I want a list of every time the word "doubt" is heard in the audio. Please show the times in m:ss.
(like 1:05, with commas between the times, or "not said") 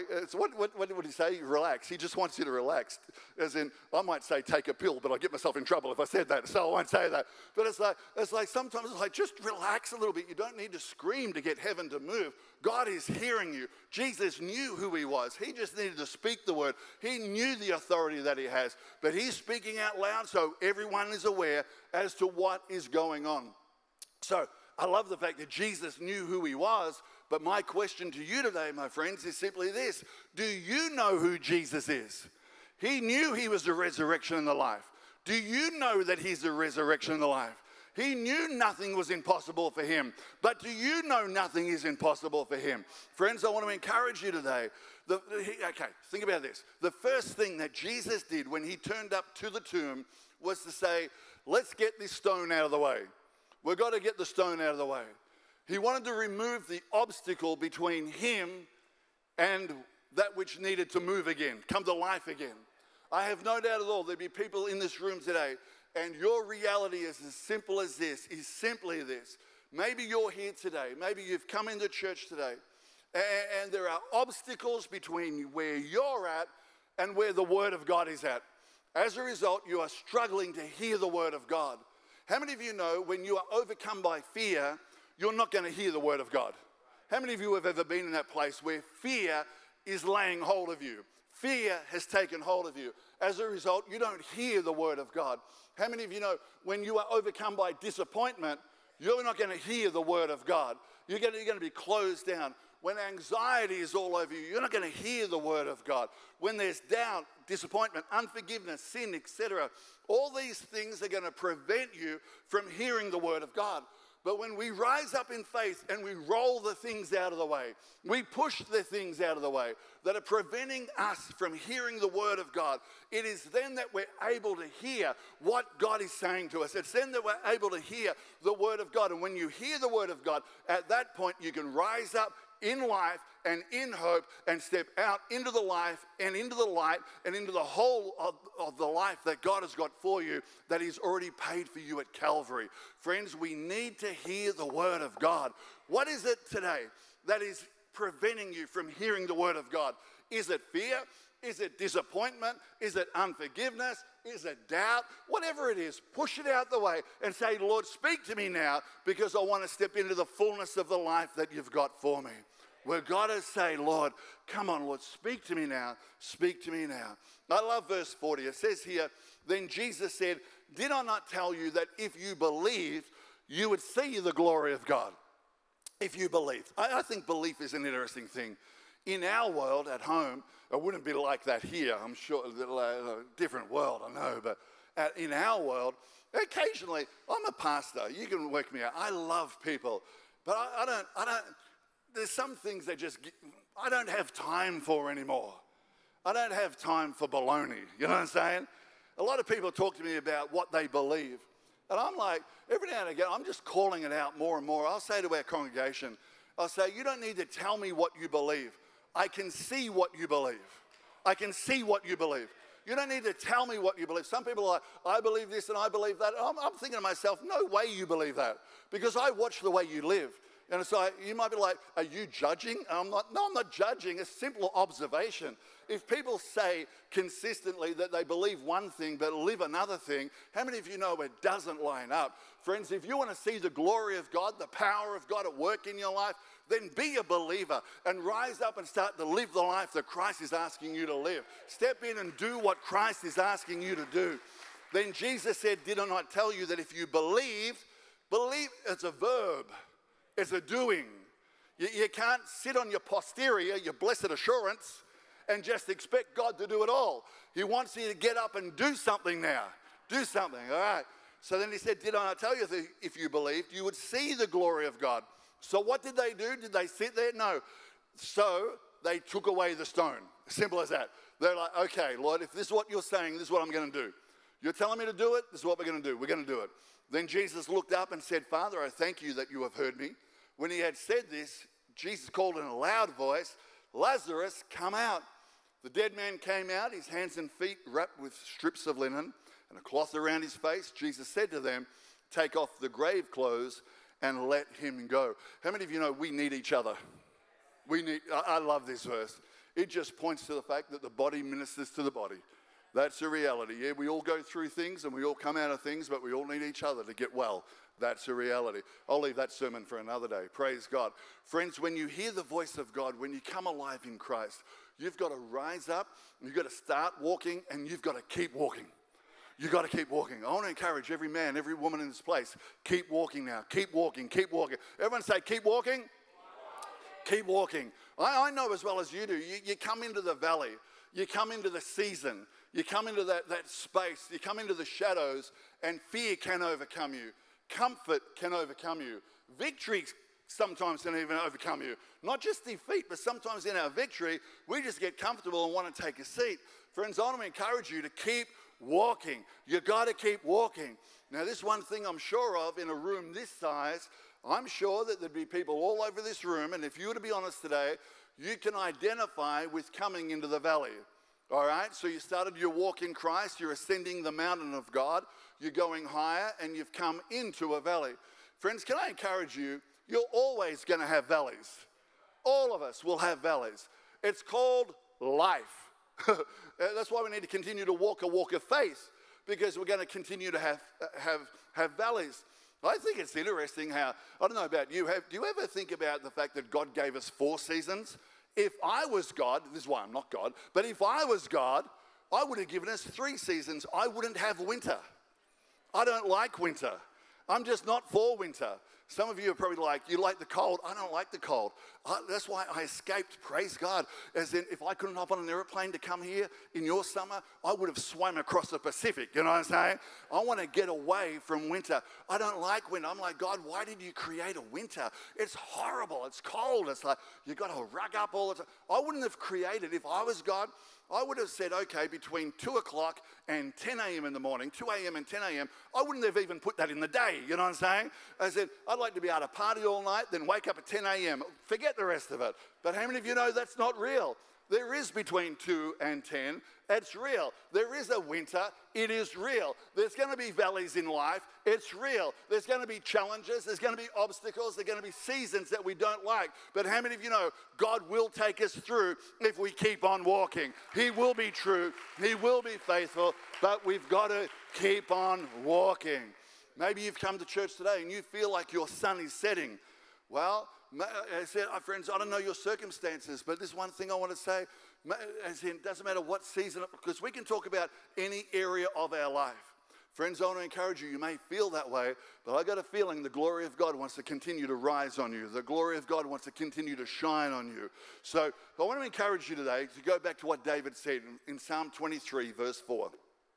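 1:03, 1:46, 2:34.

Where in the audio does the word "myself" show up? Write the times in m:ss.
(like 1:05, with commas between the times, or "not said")
0:05, 3:37.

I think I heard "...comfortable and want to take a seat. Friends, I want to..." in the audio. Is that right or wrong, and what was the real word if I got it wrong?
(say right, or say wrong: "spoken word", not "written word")
right.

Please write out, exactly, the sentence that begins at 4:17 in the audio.
He wants you to get up and do something now.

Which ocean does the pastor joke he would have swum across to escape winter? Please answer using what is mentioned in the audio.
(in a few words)
Pacific.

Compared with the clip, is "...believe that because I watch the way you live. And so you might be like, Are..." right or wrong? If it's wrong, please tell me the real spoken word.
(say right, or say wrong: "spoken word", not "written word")
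right.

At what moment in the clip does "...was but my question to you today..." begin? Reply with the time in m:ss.
0:26.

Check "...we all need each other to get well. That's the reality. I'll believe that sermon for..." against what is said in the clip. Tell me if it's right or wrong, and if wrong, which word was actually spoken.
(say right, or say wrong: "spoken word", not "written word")
wrong: "leave", not "believe".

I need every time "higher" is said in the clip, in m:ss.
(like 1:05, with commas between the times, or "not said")
6:06.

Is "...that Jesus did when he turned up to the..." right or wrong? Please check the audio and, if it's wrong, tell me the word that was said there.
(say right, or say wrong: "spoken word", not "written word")
right.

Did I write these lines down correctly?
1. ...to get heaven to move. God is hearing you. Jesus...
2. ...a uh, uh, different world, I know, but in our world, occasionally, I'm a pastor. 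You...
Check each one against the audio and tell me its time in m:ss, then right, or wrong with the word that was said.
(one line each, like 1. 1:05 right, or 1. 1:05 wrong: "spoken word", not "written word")
1. 0:11 right
2. 3:02 right.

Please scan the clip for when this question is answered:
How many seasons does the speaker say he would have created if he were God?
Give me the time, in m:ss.
6:33.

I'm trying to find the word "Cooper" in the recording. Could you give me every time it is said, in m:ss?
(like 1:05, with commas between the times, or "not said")
not said.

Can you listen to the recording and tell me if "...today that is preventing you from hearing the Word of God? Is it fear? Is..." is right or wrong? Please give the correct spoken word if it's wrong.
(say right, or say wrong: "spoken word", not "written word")
right.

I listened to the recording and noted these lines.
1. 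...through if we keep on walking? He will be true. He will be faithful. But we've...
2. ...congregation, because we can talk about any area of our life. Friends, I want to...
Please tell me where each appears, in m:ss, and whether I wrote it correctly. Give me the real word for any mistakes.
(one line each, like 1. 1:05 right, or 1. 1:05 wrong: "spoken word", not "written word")
1. 7:28 right
2. 7:46 wrong: "season", not "congregation".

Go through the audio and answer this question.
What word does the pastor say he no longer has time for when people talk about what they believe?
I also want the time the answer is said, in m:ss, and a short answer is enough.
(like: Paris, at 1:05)
baloney, at 3:17.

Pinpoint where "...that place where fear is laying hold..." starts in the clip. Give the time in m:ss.
1:28.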